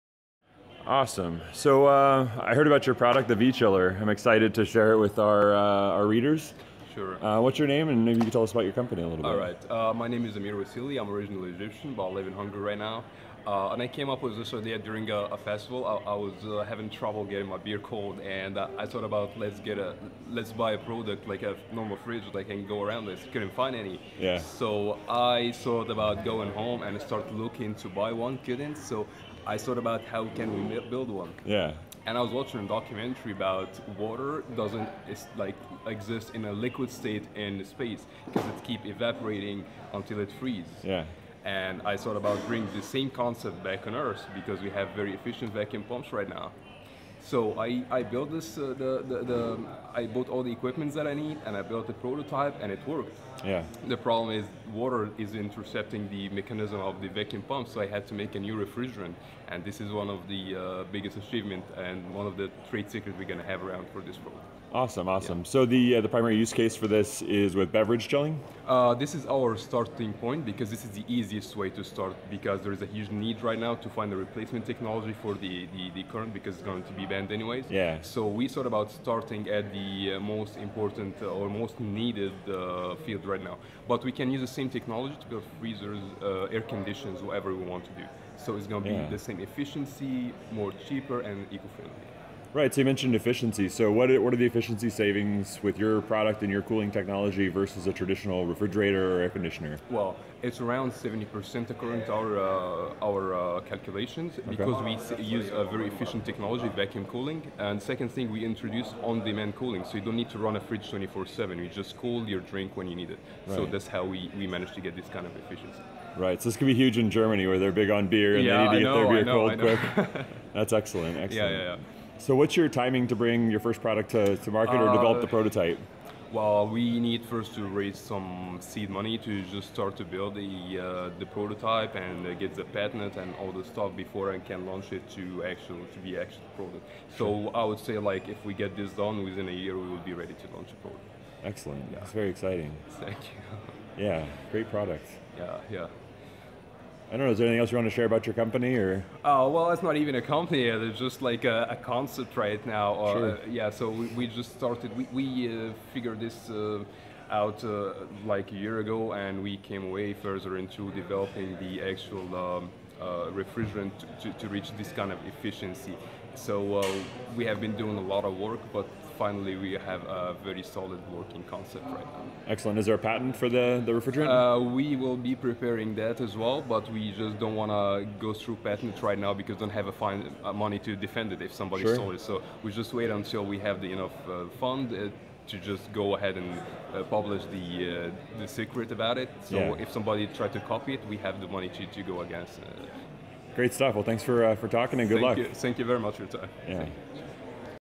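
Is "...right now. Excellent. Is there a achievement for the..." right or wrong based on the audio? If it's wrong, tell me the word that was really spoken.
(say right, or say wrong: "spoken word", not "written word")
wrong: "patent", not "achievement".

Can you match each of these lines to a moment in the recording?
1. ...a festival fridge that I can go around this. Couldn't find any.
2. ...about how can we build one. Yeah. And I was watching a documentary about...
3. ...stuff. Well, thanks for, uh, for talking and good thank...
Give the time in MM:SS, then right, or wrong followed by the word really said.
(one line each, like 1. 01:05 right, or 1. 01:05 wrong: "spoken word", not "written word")
1. 00:21 wrong: "normal", not "festival"
2. 00:29 right
3. 03:13 right.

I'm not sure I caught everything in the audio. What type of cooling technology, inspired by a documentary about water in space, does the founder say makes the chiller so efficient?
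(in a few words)
vacuum cooling.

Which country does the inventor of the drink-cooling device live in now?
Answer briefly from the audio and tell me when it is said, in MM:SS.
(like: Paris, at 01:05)
Hungary, at 00:12.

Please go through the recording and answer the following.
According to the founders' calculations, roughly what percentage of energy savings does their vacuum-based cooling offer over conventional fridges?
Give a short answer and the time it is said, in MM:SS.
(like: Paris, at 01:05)
70%, at 01:40.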